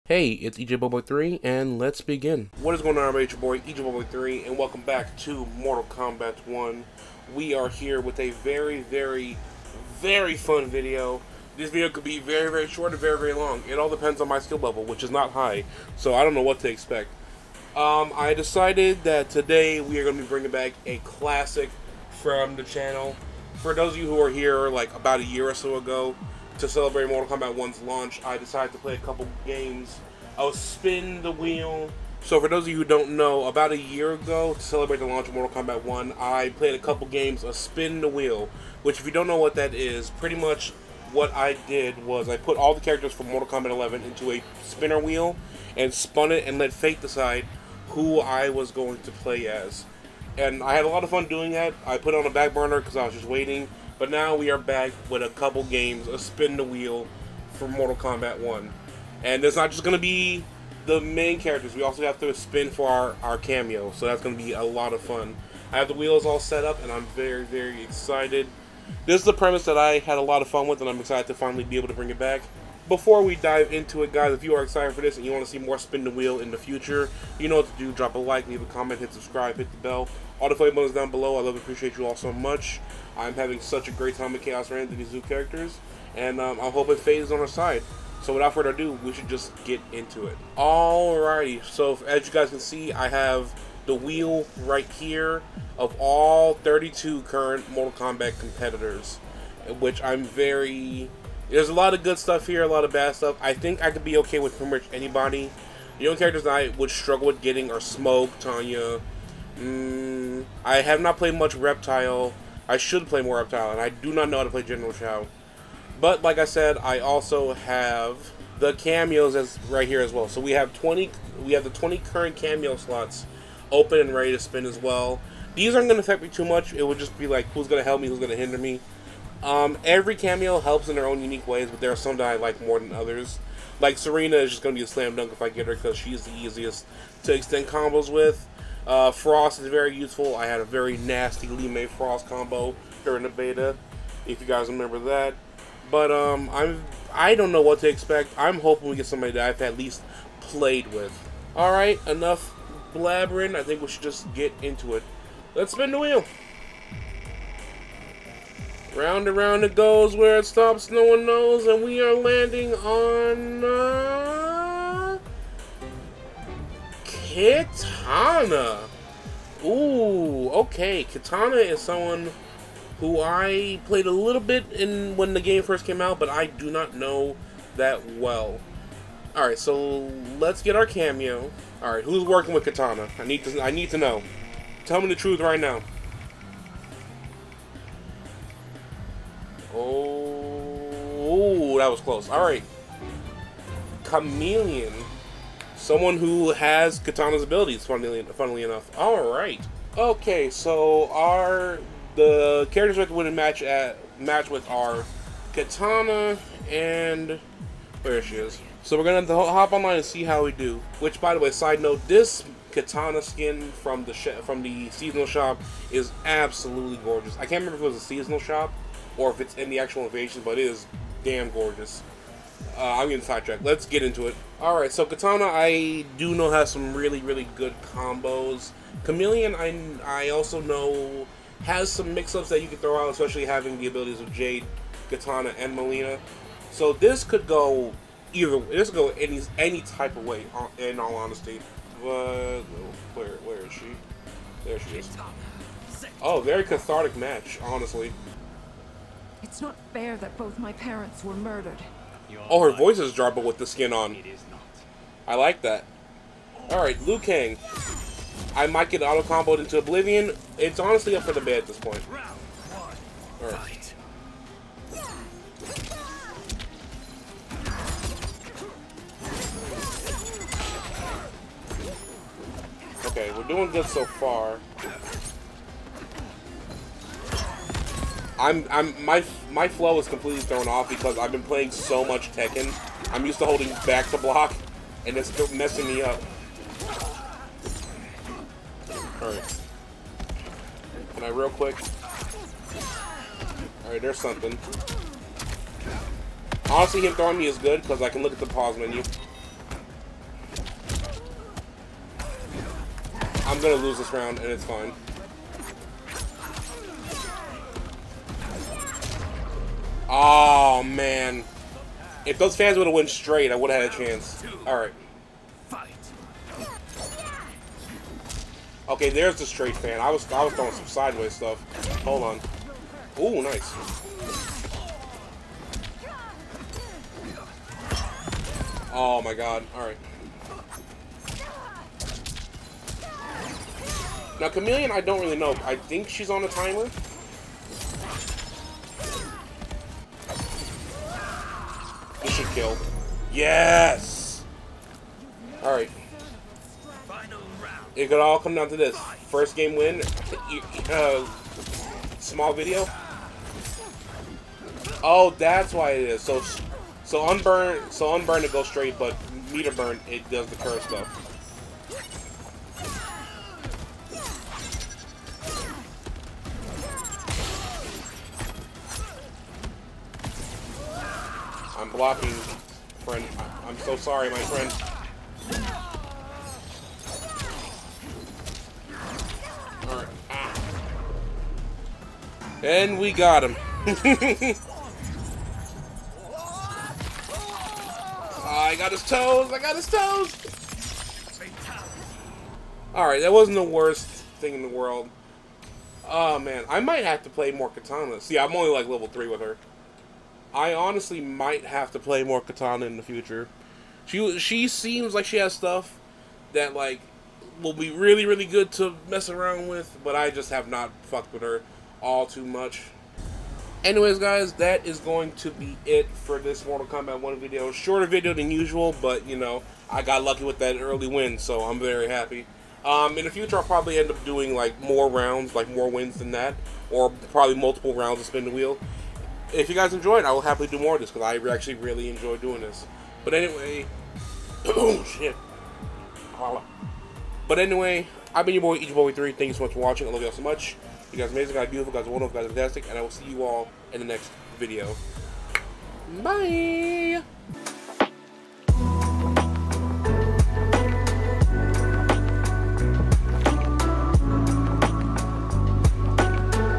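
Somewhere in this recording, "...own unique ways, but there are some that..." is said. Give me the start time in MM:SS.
02:11.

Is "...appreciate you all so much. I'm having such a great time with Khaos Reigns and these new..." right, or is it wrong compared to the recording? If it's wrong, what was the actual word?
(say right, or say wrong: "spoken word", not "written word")
right.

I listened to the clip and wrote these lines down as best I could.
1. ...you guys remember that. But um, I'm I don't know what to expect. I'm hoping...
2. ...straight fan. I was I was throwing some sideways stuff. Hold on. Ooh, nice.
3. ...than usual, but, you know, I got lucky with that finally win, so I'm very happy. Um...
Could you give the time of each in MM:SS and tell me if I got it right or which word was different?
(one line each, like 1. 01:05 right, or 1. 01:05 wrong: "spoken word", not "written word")
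1. 02:24 right
2. 05:19 right
3. 06:58 wrong: "early", not "finally".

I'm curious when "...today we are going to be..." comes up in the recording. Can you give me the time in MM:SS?
00:19.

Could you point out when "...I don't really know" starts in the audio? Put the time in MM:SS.
05:34.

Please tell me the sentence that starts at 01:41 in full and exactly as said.
There's a lot of good stuff here, a lot of bad stuff.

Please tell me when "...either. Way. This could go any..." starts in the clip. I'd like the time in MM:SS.
03:58.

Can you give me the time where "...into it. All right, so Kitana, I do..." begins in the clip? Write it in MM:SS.
03:44.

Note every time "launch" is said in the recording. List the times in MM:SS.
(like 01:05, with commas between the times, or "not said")
00:27, 00:35.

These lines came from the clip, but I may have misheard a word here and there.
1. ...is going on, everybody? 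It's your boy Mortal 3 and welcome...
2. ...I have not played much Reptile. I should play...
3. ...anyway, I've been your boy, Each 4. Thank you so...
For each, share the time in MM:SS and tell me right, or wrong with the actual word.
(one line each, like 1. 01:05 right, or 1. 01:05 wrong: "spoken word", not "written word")
1. 00:02 wrong: "Bugboy", not "Mortal"
2. 01:50 right
3. 07:17 wrong: "3", not "4".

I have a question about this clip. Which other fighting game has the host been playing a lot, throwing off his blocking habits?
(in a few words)
Tekken.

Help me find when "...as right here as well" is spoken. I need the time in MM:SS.
01:59.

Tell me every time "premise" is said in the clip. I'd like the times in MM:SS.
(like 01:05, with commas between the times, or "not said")
01:09.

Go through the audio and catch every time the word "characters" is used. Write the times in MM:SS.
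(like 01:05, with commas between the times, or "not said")
00:42, 01:01, 01:25, 01:46, 03:22.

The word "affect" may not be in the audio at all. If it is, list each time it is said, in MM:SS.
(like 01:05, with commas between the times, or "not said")
02:06.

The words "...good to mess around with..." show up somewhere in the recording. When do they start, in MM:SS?
06:48.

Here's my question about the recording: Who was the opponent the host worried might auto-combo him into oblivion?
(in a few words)
Liu Kang.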